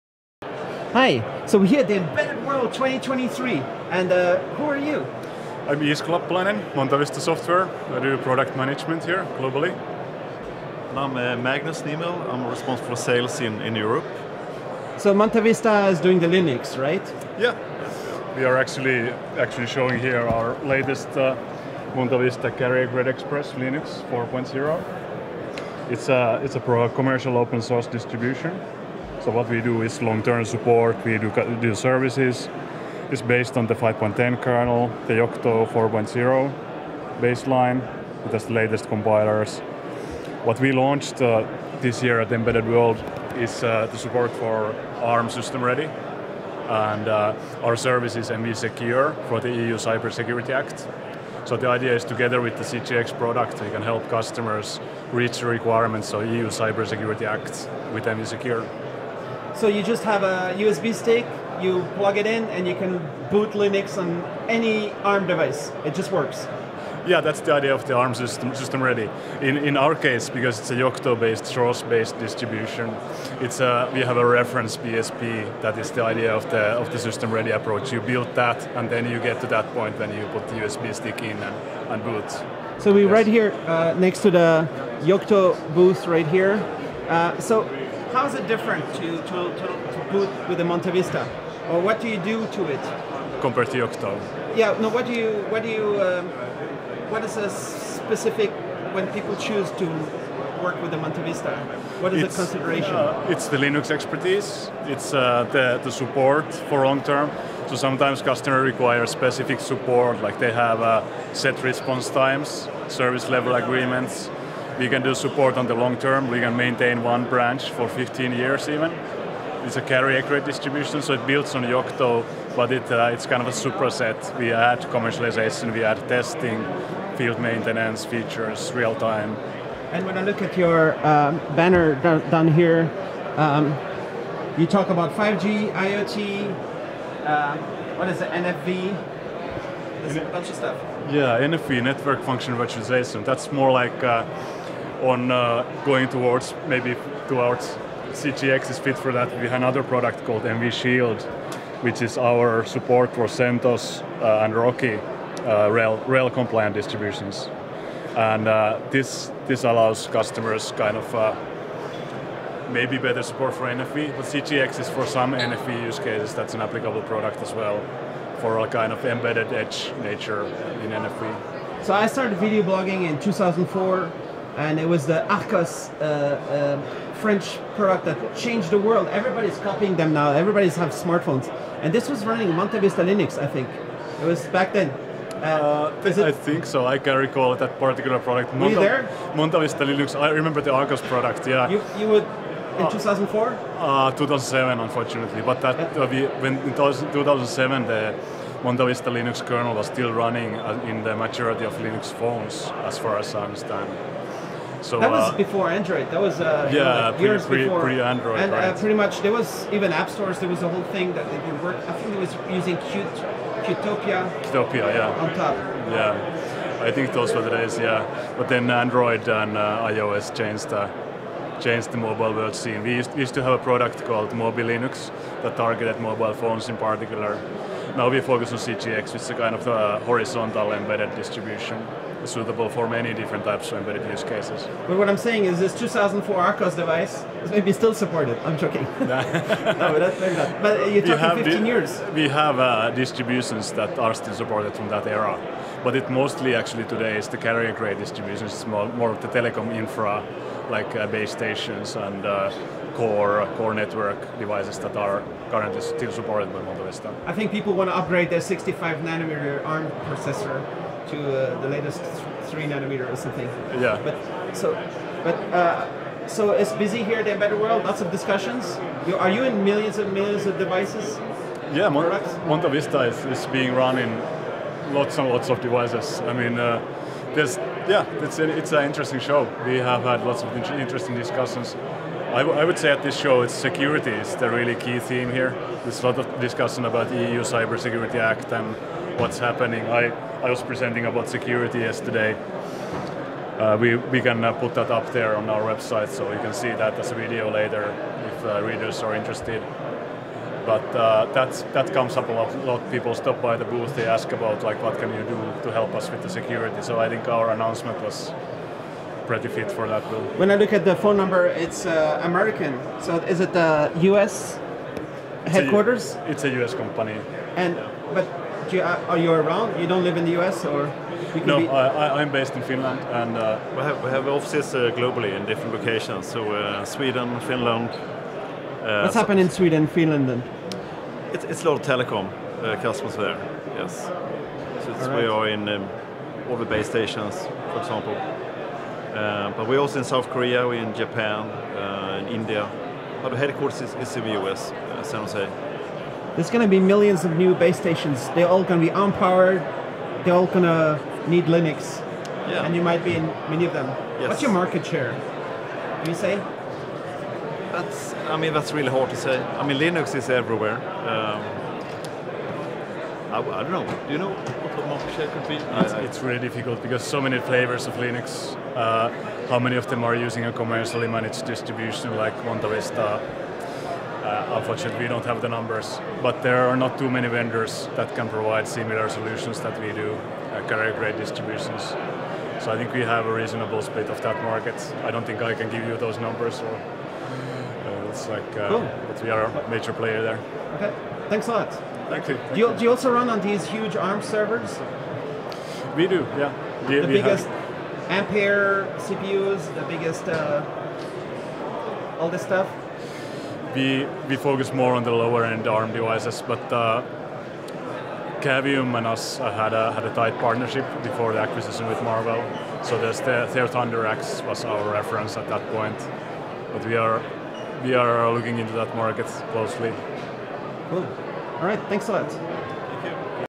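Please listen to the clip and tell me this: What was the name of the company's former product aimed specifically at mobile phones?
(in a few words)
Mobile Linux.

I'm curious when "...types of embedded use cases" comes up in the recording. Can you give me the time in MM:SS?
03:53.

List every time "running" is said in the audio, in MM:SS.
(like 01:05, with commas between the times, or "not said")
03:02, 03:20.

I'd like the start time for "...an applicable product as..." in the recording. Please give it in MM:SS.
02:46.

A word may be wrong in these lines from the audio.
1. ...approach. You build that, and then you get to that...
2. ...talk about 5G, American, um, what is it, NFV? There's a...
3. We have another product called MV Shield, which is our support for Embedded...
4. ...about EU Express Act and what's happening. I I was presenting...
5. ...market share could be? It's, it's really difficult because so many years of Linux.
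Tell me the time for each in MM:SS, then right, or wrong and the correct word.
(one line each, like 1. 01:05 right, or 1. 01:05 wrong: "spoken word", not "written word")
1. 01:17 right
2. 02:14 wrong: "IoT", not "American"
3. 02:29 wrong: "CentOS", not "Embedded"
4. 04:46 wrong: "Cybersecurity", not "Express"
5. 06:04 wrong: "flavors", not "years".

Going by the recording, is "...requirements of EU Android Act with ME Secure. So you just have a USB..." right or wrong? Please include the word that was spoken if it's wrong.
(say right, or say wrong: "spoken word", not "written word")
wrong: "Cybersecurity", not "Android".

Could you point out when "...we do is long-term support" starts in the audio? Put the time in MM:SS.
00:29.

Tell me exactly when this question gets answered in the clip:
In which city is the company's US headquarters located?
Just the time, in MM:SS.
05:45.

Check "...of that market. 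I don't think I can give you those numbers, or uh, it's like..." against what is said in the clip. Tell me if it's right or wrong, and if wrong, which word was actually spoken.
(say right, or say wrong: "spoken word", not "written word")
right.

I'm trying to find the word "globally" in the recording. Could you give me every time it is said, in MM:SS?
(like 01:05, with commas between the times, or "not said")
00:09, 05:24.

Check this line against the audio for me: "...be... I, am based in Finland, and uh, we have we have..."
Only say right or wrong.
right.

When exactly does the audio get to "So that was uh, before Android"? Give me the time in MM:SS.
03:24.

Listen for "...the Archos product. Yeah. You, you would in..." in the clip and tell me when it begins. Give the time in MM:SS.
03:10.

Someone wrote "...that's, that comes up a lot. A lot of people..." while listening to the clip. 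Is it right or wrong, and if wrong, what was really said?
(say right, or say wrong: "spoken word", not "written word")
right.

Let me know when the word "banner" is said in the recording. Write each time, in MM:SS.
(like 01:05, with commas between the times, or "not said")
02:11.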